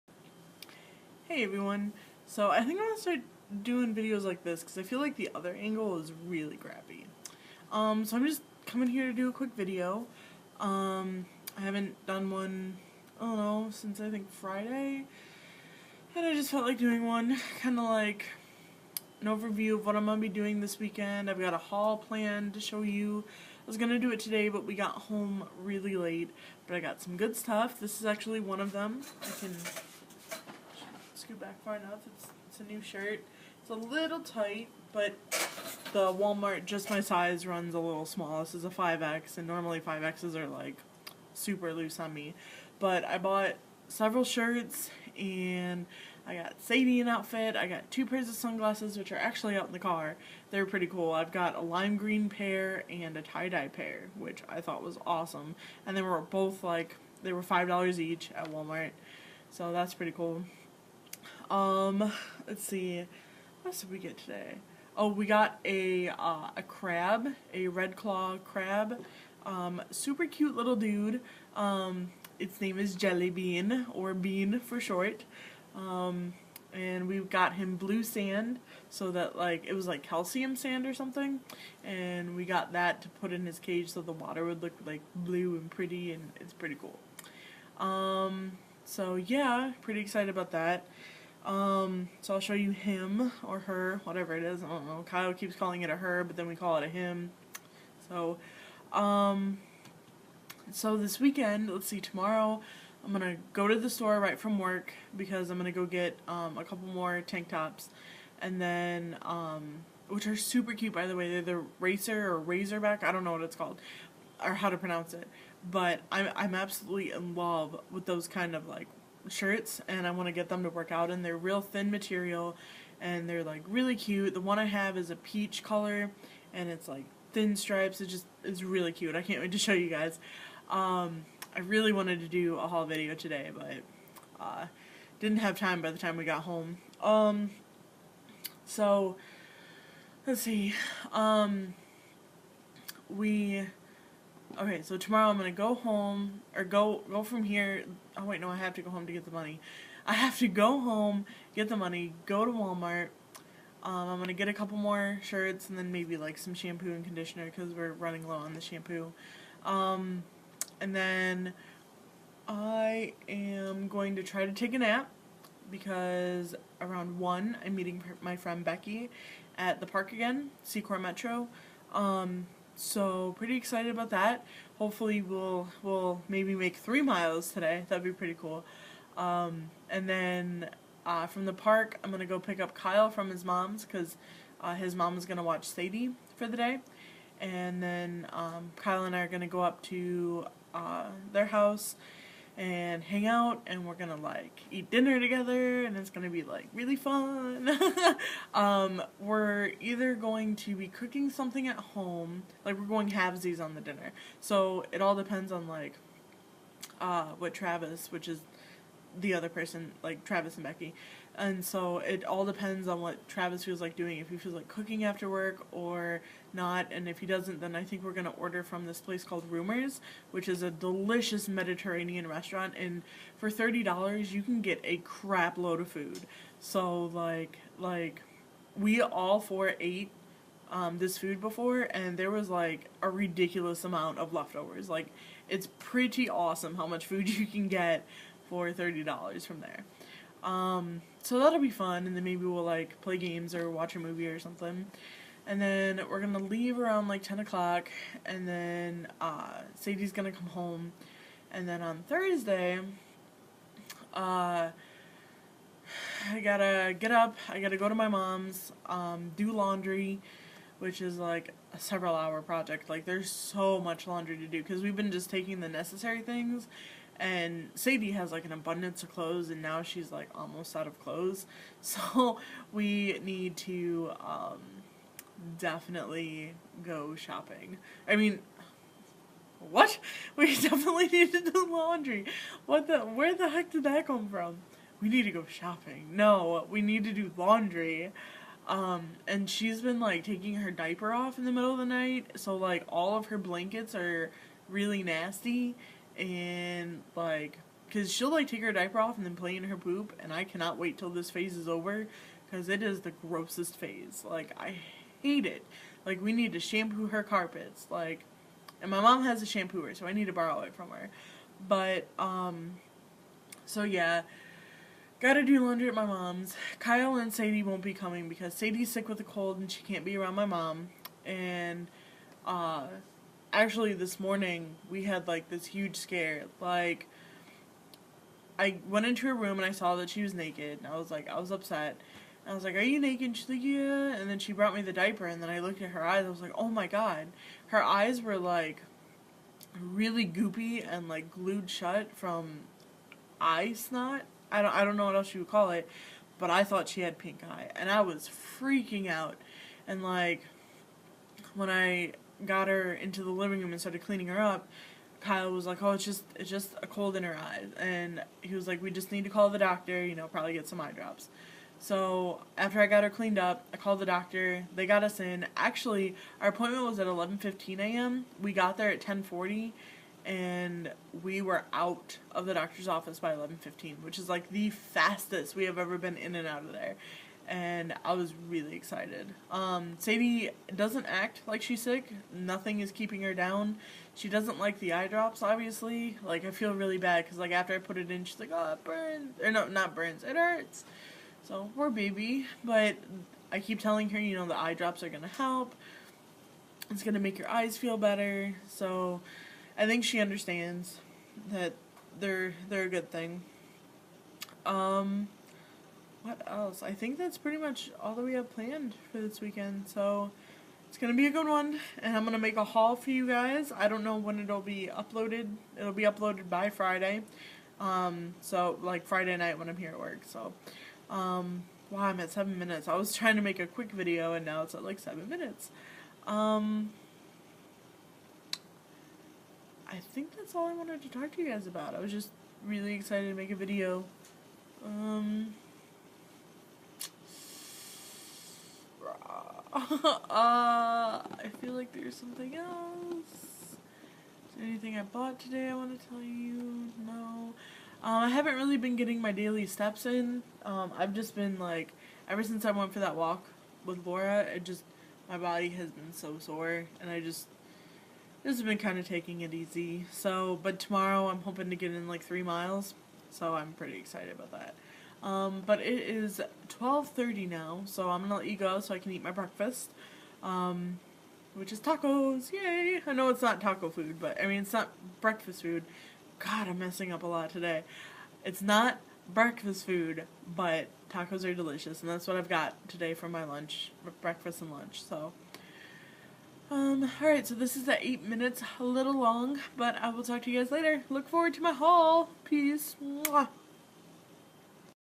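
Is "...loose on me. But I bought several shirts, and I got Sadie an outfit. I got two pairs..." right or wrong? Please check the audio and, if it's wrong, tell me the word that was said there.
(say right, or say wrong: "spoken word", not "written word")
right.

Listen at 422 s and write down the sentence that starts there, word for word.
I was trying to make a quick video and now it's at like seven minutes.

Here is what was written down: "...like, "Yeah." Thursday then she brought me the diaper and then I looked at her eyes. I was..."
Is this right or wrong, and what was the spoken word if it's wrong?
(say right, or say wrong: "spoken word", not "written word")
wrong: "And", not "Thursday".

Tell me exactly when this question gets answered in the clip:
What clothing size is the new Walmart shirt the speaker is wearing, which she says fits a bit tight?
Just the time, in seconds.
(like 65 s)
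38 s.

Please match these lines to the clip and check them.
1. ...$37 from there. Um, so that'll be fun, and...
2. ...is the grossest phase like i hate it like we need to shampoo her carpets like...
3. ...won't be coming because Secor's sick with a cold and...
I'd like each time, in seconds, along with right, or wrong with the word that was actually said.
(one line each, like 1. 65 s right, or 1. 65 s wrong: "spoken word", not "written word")
1. 238 s wrong: "30", not "37"
2. 302 s right
3. 317 s wrong: "Sadie", not "Secor".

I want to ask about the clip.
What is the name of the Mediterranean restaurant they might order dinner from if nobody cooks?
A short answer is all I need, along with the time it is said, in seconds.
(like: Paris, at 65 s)
Rumors, at 219 s.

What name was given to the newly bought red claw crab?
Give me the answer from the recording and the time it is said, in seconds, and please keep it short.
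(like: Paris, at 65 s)
Jelly Bean, at 72 s.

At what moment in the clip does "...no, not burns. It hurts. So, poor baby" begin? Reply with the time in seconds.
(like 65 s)
389 s.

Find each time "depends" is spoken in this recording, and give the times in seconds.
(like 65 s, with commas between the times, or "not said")
205 s, 212 s.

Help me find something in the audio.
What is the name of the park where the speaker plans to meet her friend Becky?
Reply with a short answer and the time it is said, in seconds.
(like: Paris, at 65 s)
Secor Metro, at 170 s.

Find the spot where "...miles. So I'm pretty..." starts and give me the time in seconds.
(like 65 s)
462 s.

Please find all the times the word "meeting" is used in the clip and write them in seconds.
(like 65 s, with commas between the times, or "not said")
167 s.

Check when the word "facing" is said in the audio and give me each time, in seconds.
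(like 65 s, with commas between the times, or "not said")
not said.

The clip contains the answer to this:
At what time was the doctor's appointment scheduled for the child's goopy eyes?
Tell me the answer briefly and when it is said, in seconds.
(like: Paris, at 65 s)
11:15 a.m., at 367 s.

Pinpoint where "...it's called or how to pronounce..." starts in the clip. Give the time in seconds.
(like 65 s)
113 s.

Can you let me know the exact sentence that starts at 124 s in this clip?
The one I have is a peach color and it's like thin stripes.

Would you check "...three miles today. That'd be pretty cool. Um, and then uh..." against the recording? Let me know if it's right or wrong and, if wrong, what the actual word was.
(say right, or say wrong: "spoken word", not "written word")
right.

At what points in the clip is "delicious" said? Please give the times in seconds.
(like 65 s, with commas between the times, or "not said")
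220 s, 481 s.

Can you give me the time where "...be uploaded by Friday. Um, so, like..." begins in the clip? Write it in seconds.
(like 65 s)
415 s.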